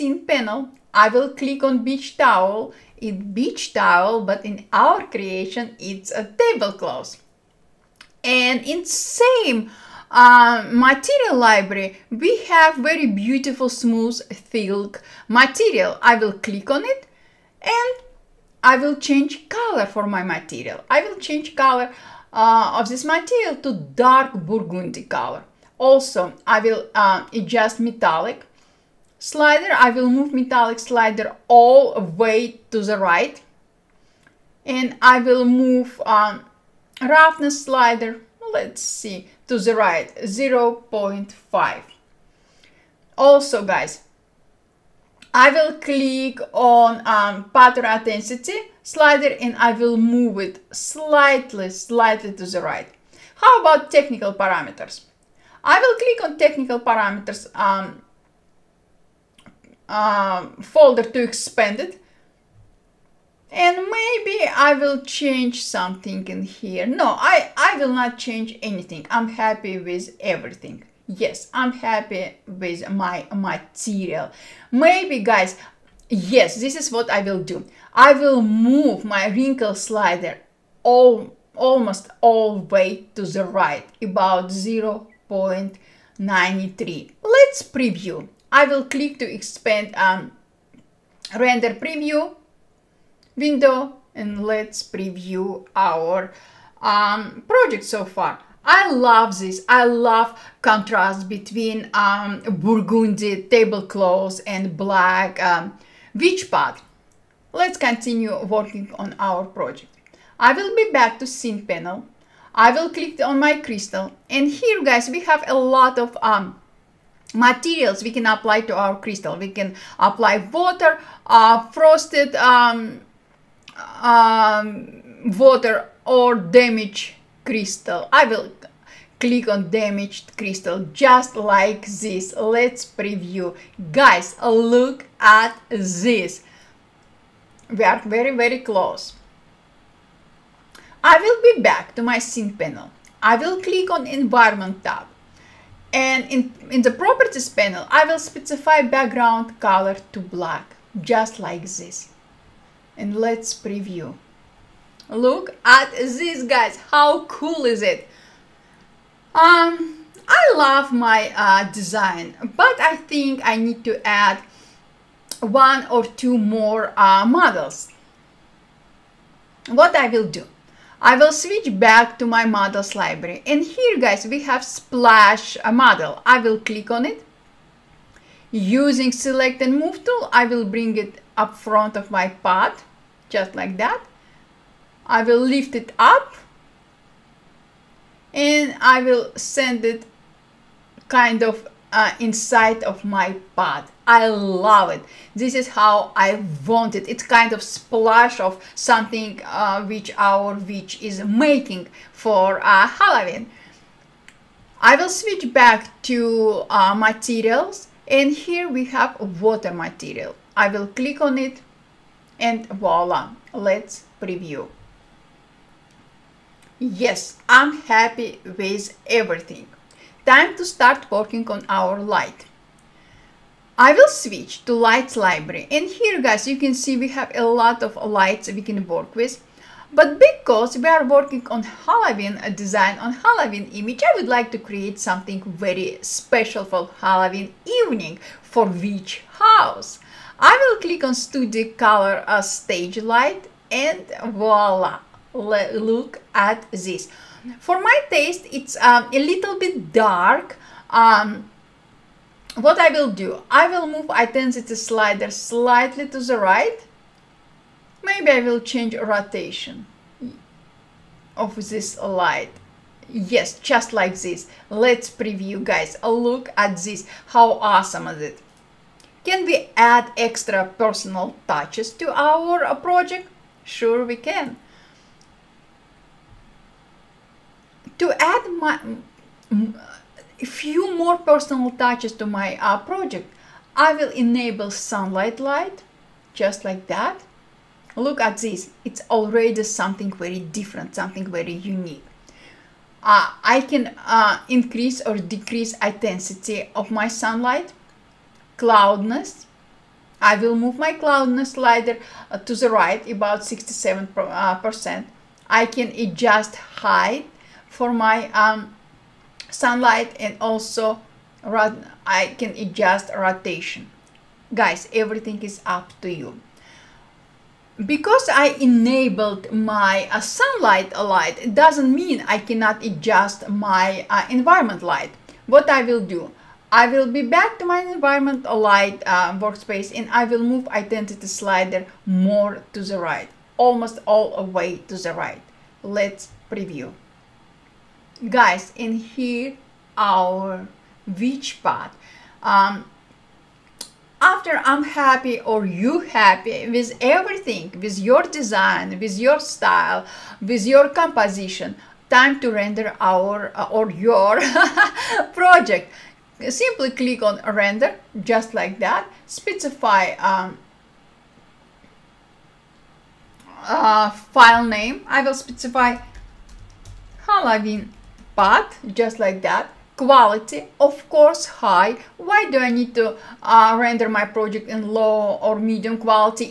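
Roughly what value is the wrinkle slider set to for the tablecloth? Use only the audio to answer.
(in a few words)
0.93.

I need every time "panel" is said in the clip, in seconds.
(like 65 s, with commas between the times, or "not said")
0 s, 111 s, 142 s, 147 s.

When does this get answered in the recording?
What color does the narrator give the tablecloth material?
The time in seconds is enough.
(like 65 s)
23 s.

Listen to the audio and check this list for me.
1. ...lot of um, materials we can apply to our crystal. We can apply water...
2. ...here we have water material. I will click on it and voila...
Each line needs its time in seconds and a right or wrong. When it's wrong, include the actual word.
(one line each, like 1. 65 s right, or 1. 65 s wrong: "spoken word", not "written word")
1. 115 s right
2. 208 s right.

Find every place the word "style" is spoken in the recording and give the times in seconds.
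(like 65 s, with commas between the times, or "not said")
349 s.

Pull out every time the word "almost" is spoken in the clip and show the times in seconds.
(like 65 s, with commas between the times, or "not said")
81 s, 333 s.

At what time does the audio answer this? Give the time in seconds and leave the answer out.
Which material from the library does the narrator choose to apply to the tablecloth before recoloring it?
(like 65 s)
13 s.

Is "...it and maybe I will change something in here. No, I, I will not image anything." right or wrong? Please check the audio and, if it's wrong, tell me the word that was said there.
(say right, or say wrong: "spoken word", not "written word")
wrong: "change", not "image".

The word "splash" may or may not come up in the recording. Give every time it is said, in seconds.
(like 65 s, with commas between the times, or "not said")
174 s, 197 s.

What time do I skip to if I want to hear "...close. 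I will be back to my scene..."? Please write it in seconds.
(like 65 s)
138 s.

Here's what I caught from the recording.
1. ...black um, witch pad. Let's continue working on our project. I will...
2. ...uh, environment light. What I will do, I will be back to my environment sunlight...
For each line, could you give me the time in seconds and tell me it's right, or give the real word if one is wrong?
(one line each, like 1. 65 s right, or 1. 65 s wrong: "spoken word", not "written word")
1. 104 s right
2. 324 s wrong: "light", not "sunlight".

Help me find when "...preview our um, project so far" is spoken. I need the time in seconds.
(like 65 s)
94 s.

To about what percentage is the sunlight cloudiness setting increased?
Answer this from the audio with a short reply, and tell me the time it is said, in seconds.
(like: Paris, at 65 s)
67%, at 303 s.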